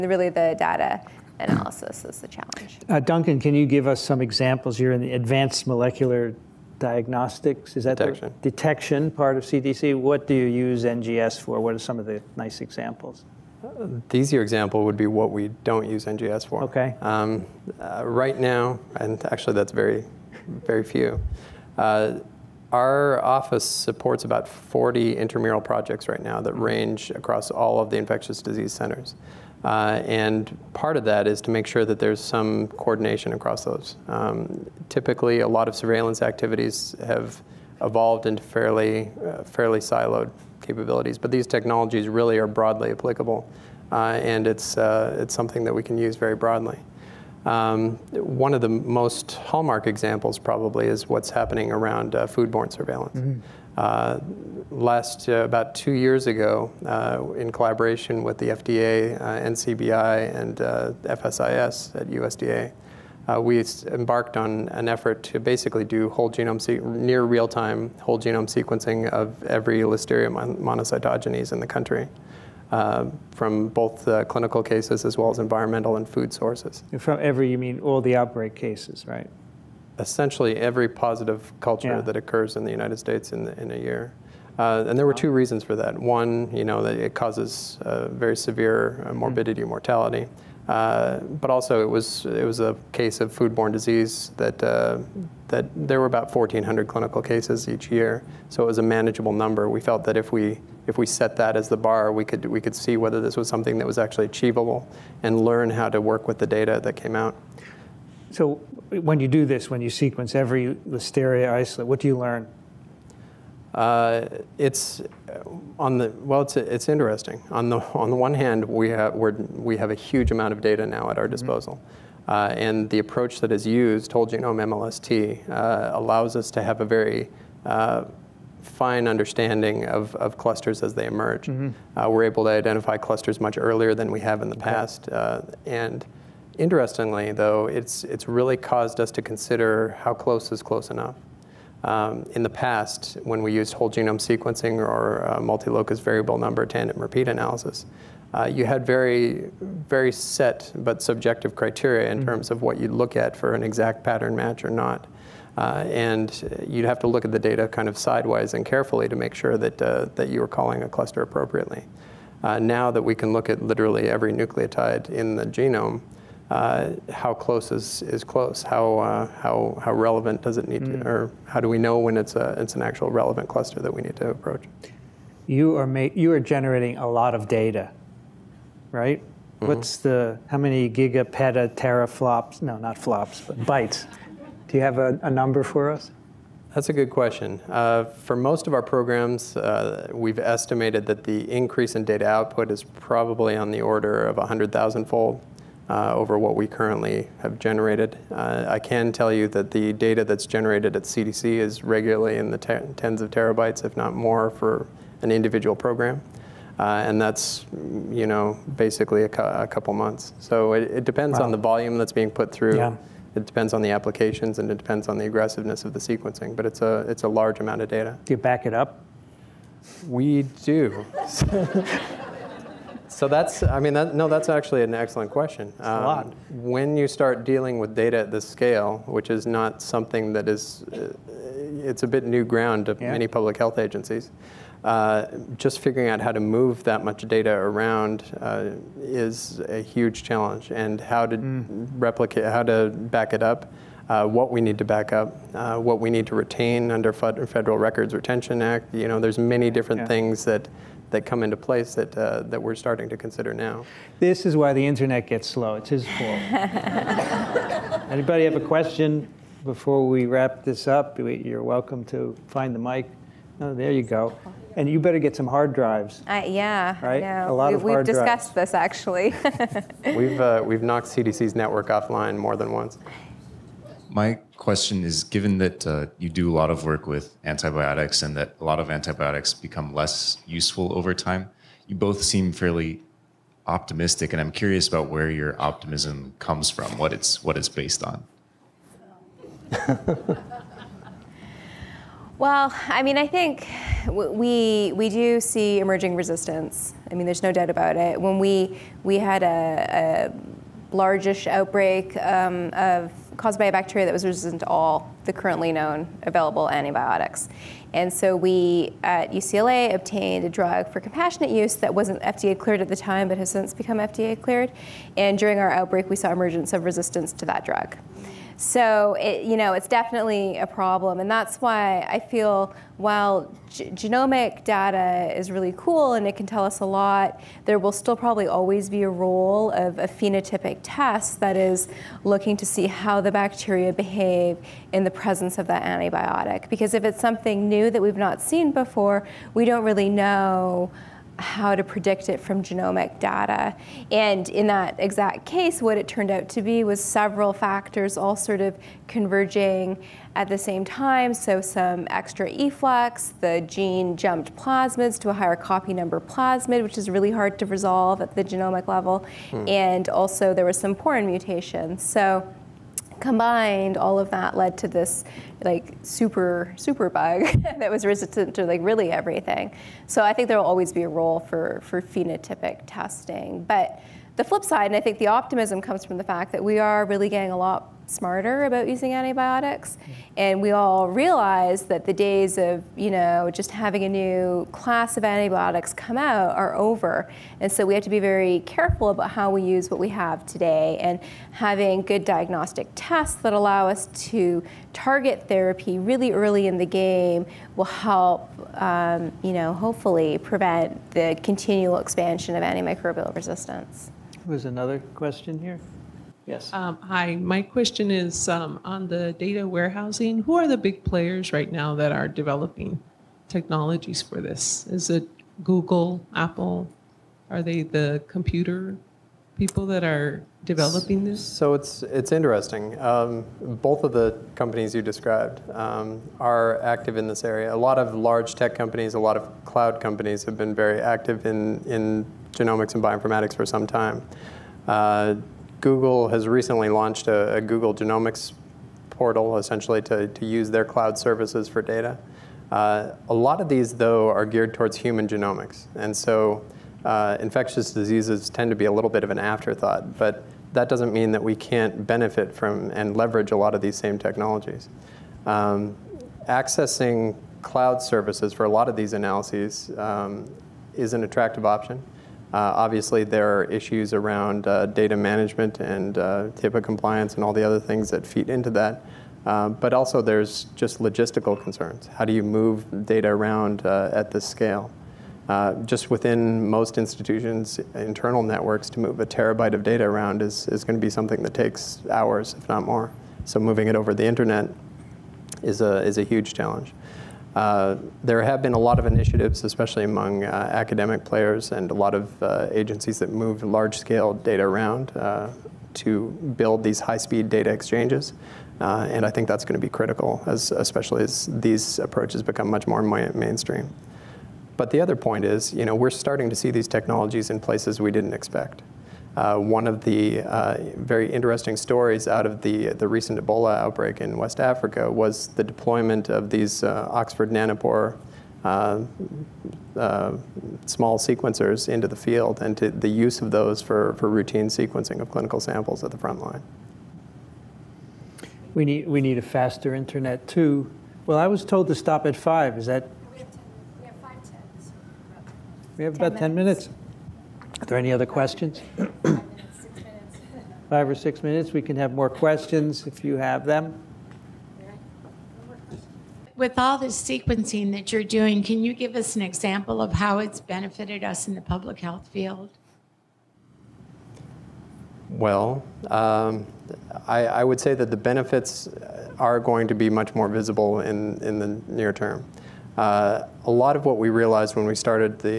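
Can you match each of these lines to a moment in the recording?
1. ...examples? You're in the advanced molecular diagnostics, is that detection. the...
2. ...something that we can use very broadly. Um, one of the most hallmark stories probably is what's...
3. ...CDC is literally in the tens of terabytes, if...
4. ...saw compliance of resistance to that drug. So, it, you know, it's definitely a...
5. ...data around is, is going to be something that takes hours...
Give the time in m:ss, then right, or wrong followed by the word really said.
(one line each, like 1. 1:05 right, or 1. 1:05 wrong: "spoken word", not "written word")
1. 0:04 right
2. 0:45 wrong: "examples", not "stories"
3. 3:21 wrong: "regularly", not "literally"
4. 5:16 wrong: "emergence", not "compliance"
5. 7:59 right.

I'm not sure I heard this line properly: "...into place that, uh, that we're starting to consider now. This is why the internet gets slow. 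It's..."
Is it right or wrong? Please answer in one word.
right.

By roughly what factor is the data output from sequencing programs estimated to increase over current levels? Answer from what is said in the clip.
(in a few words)
100,000 fold.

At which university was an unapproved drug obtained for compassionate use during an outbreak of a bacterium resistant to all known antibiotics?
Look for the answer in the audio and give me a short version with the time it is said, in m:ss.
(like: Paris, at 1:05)
UCLA, at 5:09.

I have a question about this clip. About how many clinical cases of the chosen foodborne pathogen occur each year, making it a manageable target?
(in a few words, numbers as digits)
1,400.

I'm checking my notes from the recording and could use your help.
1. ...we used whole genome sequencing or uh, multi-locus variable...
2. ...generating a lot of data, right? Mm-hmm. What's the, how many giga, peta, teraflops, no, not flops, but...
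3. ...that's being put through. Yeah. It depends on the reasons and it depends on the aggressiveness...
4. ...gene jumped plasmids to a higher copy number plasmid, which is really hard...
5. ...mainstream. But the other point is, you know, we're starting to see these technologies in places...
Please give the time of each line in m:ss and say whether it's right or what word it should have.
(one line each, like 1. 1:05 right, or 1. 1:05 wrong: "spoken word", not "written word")
1. 2:23 right
2. 2:56 right
3. 3:31 wrong: "applications", not "reasons"
4. 5:53 right
5. 8:23 right.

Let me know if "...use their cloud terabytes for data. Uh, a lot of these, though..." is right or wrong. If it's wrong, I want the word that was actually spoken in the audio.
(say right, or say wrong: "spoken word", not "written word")
wrong: "services", not "terabytes".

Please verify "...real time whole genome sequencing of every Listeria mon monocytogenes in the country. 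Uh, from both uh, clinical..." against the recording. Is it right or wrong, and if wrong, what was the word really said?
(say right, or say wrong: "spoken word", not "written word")
right.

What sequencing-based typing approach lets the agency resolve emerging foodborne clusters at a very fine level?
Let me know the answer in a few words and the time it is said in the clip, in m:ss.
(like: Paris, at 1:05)
Whole genome MLST, at 2:04.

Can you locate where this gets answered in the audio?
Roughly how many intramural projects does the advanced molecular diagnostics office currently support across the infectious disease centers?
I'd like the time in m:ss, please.
0:24.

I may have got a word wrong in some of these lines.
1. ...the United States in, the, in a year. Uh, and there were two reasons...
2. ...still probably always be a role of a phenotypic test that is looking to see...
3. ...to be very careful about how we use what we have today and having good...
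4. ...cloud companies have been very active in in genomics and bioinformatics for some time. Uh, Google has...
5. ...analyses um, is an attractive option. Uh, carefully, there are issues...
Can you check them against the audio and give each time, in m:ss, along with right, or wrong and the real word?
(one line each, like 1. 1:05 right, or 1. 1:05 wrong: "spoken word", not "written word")
1. 1:22 right
2. 5:27 right
3. 6:28 right
4. 7:09 right
5. 7:39 wrong: "obviously", not "carefully".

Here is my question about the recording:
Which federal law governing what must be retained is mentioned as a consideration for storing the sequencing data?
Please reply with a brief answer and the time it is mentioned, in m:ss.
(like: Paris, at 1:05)
Federal Records Retention Act, at 4:07.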